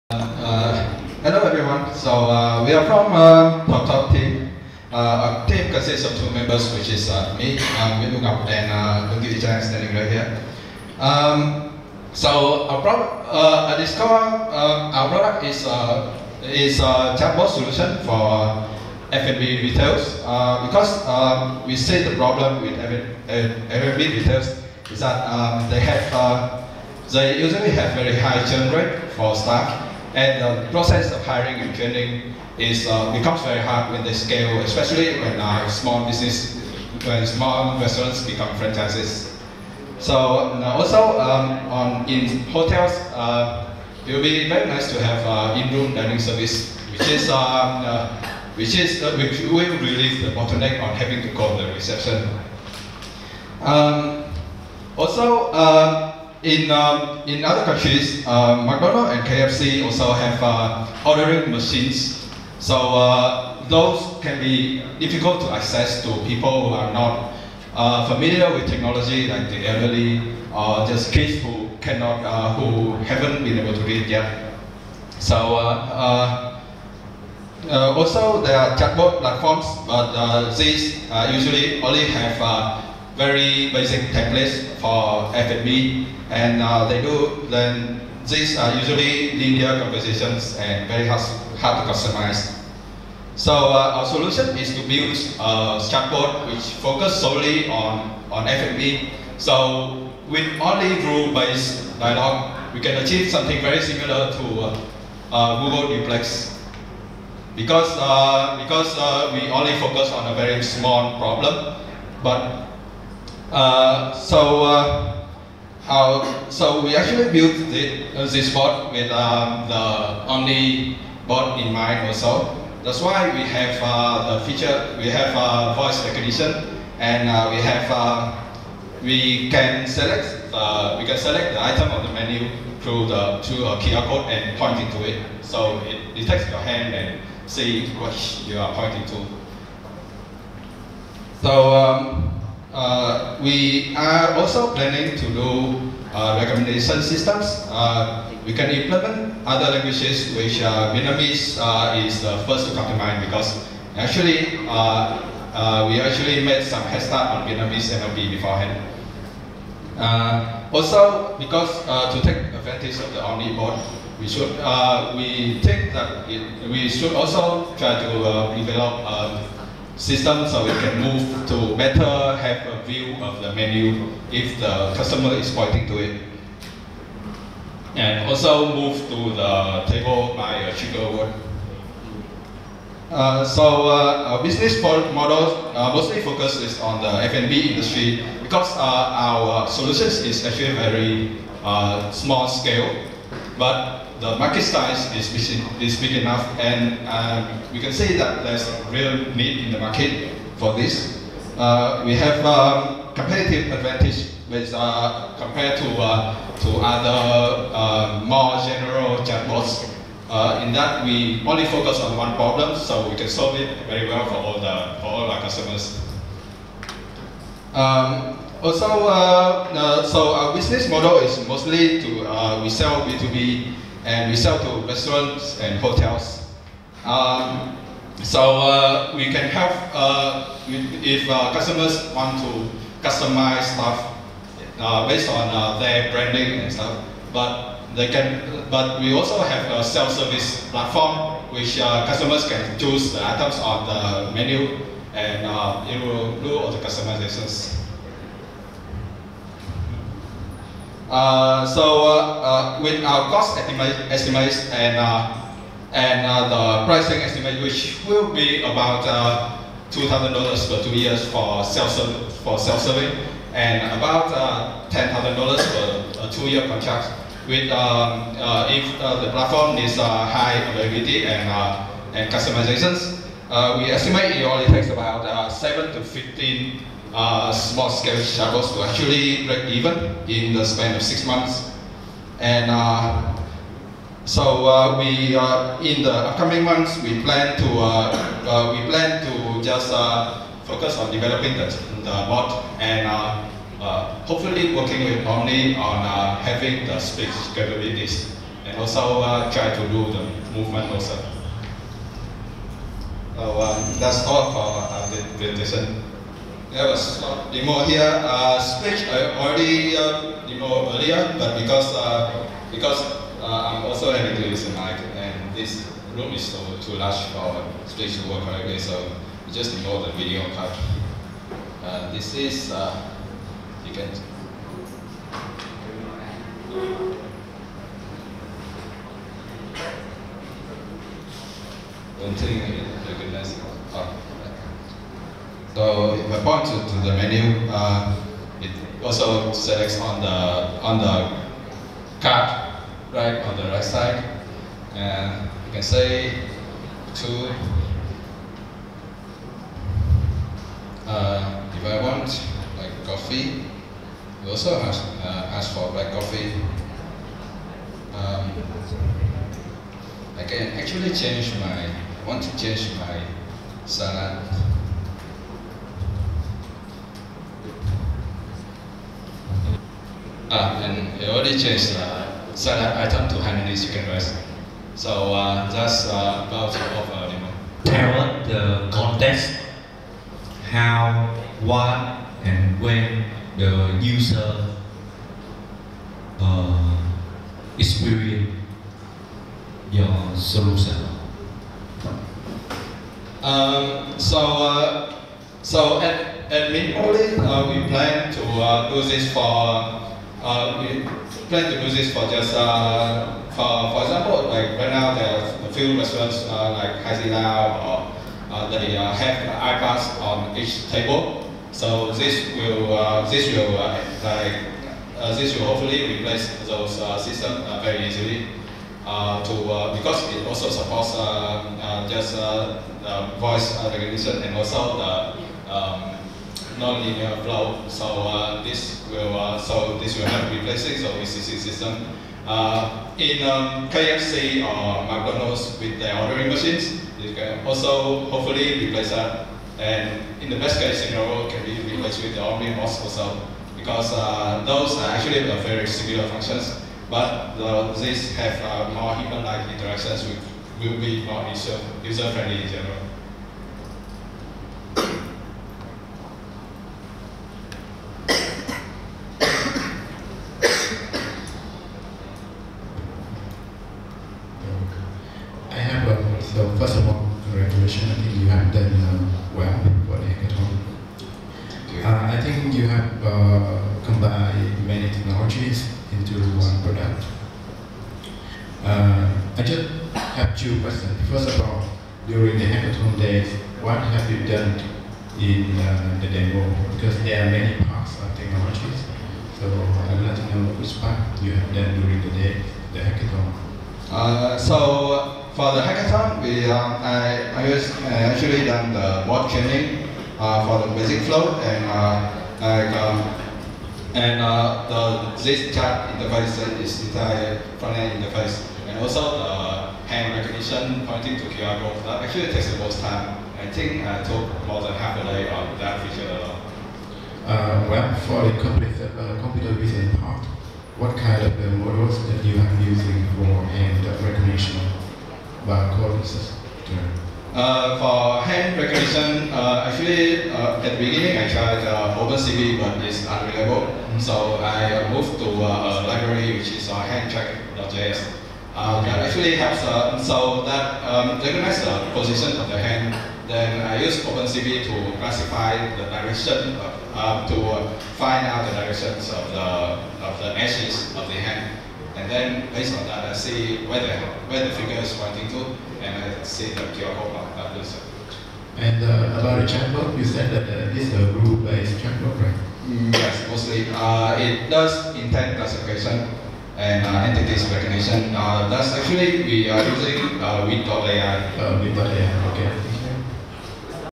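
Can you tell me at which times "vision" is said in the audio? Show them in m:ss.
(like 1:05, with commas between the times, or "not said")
8:39.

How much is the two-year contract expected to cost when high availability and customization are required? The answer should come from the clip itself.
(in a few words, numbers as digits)
$10,000.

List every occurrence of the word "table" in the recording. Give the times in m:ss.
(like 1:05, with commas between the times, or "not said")
2:59, 6:50.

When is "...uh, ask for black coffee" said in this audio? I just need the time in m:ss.
5:55.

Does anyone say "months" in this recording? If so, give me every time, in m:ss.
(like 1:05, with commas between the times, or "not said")
4:41, 4:46.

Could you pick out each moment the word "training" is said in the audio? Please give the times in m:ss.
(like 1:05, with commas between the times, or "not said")
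0:31, 8:19.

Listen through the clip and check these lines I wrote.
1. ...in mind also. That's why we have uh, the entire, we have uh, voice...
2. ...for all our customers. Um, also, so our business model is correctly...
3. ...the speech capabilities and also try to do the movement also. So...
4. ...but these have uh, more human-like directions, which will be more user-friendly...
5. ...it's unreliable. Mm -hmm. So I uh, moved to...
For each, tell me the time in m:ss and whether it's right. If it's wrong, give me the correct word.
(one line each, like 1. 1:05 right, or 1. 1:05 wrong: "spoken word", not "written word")
1. 2:01 wrong: "feature", not "entire"
2. 3:35 wrong: "mostly", not "correctly"
3. 4:56 right
4. 7:27 wrong: "interactions", not "directions"
5. 8:53 right.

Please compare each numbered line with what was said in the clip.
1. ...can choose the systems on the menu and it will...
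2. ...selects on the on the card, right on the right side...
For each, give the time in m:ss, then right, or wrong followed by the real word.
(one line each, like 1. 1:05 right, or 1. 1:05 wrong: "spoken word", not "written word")
1. 4:02 wrong: "items", not "systems"
2. 5:39 right.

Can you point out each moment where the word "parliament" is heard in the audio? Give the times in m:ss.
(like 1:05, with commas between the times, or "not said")
not said.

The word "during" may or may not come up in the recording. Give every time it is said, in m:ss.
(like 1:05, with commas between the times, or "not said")
8:02, 8:12.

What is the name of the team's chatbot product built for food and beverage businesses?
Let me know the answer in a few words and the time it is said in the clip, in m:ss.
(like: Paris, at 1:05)
Discover, at 0:13.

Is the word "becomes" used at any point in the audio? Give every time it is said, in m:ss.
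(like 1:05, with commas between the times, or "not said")
0:33, 0:38.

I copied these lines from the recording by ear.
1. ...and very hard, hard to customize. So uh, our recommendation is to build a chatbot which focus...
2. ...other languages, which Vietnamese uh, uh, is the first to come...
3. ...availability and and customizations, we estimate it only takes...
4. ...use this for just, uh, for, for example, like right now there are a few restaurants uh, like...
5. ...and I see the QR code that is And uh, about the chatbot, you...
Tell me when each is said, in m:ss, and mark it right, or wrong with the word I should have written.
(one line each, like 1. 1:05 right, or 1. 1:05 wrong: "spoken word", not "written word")
1. 1:30 wrong: "solution", not "recommendation"
2. 2:29 right
3. 4:30 right
4. 6:41 right
5. 9:16 right.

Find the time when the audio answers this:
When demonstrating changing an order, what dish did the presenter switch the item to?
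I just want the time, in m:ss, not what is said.
6:13.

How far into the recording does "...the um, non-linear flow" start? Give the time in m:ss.
7:04.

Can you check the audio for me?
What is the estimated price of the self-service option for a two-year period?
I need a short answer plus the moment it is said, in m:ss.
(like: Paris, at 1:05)
$2,000, at 4:19.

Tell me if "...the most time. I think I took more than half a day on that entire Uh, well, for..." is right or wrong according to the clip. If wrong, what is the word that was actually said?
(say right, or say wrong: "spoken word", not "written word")
wrong: "feature", not "entire".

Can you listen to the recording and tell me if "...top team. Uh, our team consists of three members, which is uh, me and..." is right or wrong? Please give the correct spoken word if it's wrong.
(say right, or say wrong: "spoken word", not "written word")
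wrong: "two", not "three".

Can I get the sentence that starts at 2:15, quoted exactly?
So it detects your hand and see what you are pointing to.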